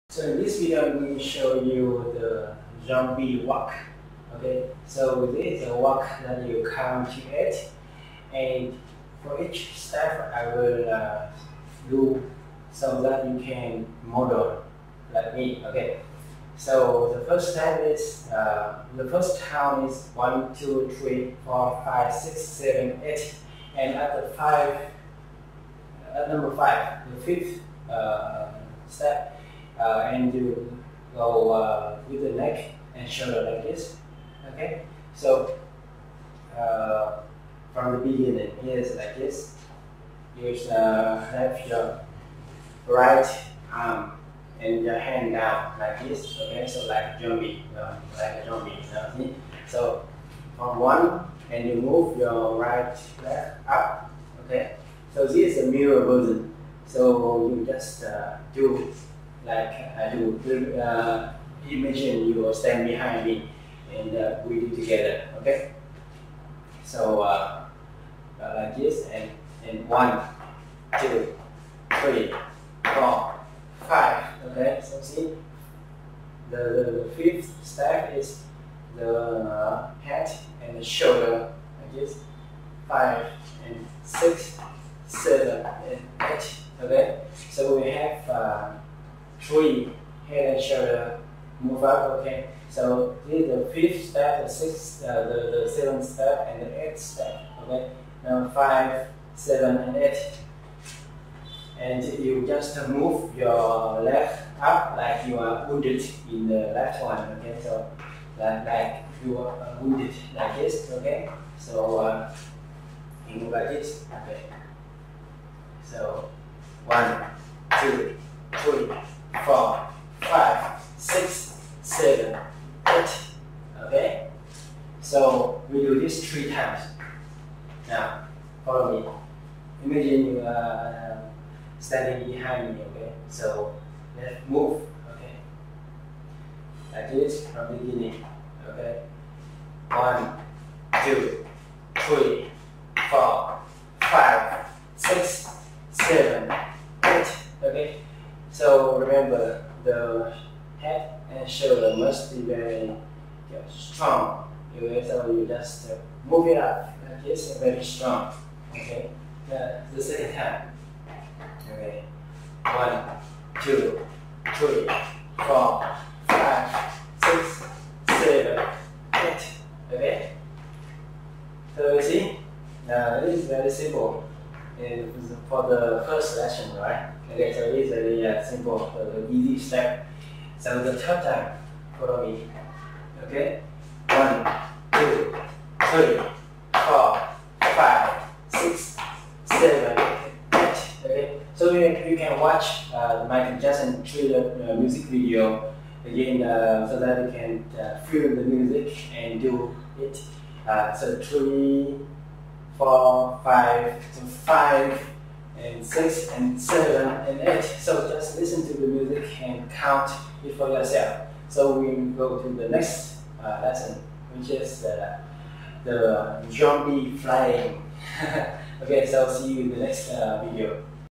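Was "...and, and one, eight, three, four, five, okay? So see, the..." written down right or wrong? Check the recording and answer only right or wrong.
wrong.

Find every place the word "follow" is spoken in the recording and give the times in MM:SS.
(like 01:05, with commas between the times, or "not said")
02:08, 03:01.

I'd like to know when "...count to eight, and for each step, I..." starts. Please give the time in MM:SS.
00:06.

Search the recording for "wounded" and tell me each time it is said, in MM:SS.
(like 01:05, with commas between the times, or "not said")
01:45, 01:49.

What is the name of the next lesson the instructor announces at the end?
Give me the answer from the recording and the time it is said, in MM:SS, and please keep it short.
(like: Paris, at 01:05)
zombie flying, at 03:36.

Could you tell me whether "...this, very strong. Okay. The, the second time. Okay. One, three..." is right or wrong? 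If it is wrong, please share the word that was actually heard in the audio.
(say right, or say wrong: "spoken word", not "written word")
wrong: "two", not "three".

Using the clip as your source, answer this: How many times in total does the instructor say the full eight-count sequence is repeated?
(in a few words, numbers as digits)
3.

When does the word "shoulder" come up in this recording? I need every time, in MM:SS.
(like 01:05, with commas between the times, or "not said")
00:33, 01:20, 01:30, 02:31.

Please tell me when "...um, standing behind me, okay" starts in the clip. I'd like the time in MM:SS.
02:11.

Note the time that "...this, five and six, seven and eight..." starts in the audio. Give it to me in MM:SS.
01:21.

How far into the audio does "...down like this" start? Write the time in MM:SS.
00:45.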